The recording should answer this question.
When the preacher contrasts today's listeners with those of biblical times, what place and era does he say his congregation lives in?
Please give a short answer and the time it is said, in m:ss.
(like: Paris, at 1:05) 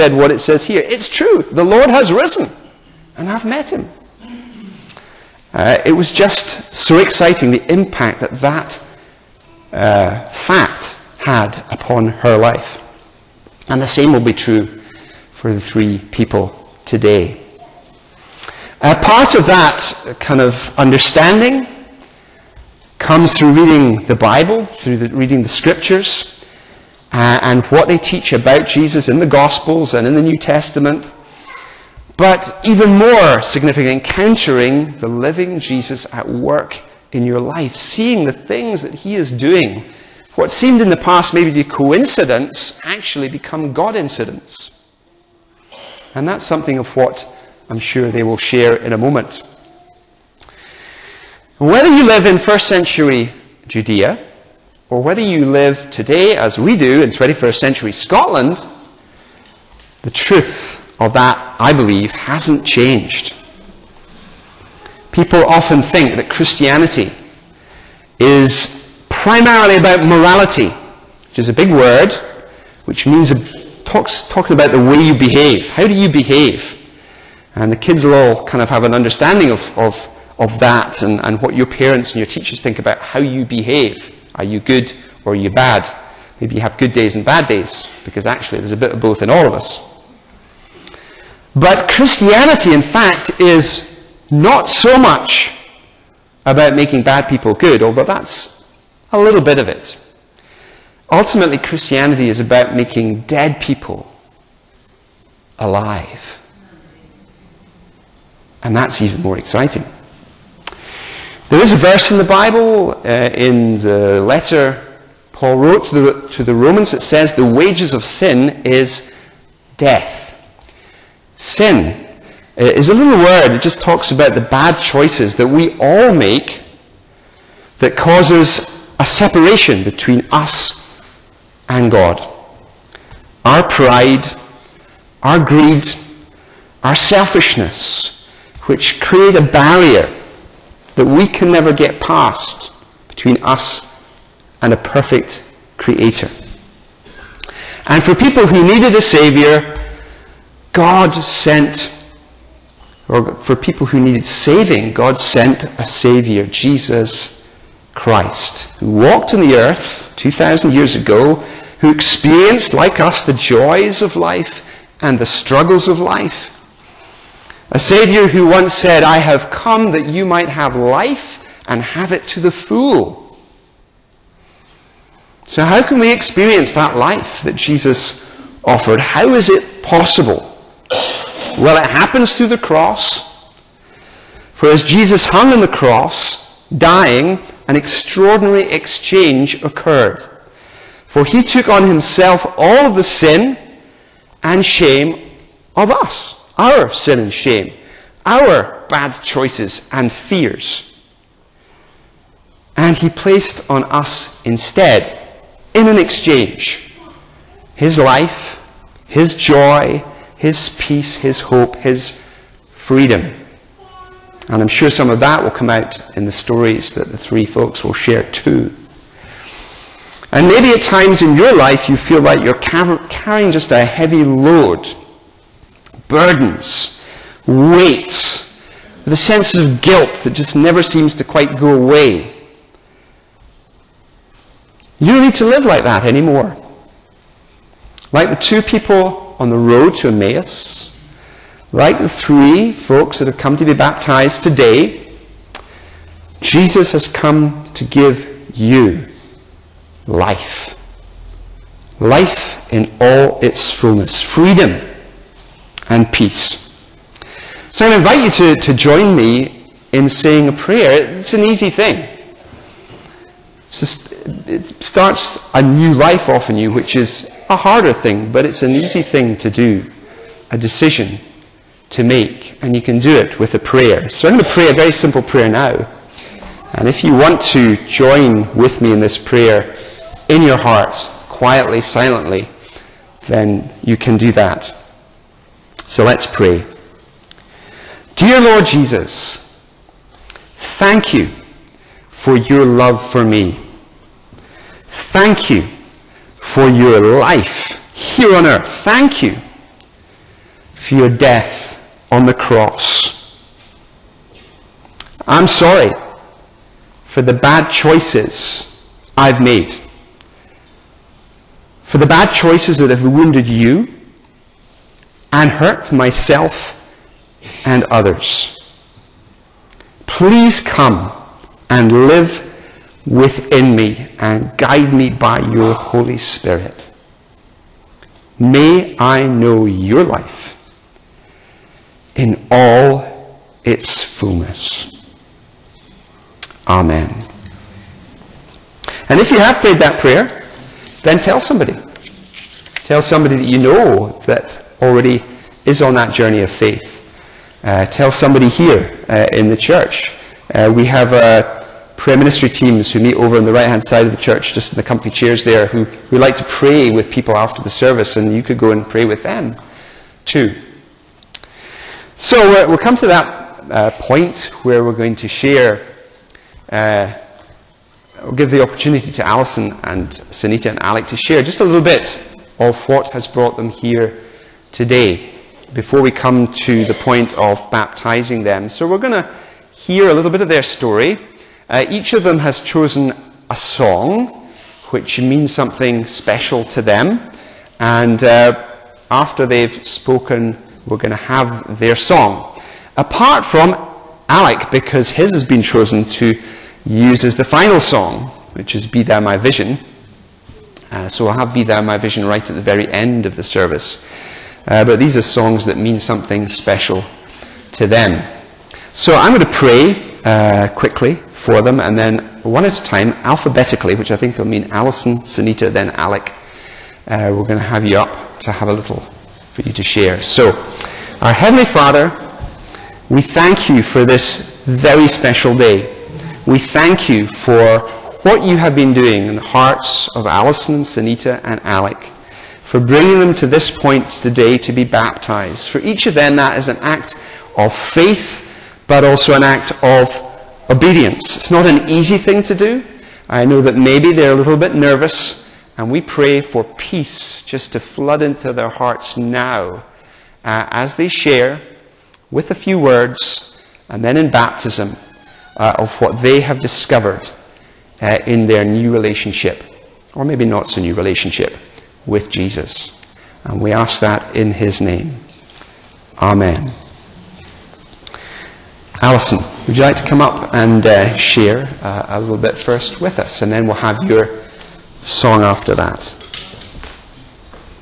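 21st century Scotland, at 0:57.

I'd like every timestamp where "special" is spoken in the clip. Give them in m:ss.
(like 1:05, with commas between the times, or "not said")
6:26, 6:46, 7:05.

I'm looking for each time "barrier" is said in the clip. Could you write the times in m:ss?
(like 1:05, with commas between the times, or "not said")
2:19.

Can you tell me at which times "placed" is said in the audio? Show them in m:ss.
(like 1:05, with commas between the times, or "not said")
3:23.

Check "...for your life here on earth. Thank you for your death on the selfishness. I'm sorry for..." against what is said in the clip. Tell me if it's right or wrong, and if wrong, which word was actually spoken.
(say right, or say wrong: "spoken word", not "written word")
wrong: "cross", not "selfishness".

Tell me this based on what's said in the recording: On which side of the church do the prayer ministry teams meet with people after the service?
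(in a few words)
right hand side.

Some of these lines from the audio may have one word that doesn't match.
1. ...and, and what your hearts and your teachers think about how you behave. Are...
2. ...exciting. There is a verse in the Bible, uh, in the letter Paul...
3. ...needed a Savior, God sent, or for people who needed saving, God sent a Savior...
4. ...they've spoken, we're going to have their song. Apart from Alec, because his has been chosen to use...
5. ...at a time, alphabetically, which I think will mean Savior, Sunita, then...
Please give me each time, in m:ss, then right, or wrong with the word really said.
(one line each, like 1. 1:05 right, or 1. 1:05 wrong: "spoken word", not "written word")
1. 1:21 wrong: "parents", not "hearts"
2. 1:49 right
3. 2:28 right
4. 6:29 right
5. 6:52 wrong: "Alison", not "Savior".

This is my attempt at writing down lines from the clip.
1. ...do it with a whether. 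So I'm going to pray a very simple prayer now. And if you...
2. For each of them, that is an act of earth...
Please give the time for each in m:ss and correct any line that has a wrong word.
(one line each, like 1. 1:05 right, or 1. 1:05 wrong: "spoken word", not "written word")
1. 4:32 wrong: "prayer", not "whether"
2. 7:15 wrong: "faith", not "earth".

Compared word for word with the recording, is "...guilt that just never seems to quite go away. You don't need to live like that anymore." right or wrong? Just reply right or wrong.
right.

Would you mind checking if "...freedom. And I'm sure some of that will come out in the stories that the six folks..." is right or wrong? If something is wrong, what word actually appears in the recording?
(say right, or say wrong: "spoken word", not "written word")
wrong: "three", not "six".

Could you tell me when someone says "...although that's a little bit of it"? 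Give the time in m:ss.
1:37.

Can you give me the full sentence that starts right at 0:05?
Uh, it was just so exciting the impact that that uh, fact had upon her life.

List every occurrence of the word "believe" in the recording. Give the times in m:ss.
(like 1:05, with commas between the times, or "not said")
1:01.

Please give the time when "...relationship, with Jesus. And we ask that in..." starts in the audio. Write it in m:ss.
7:40.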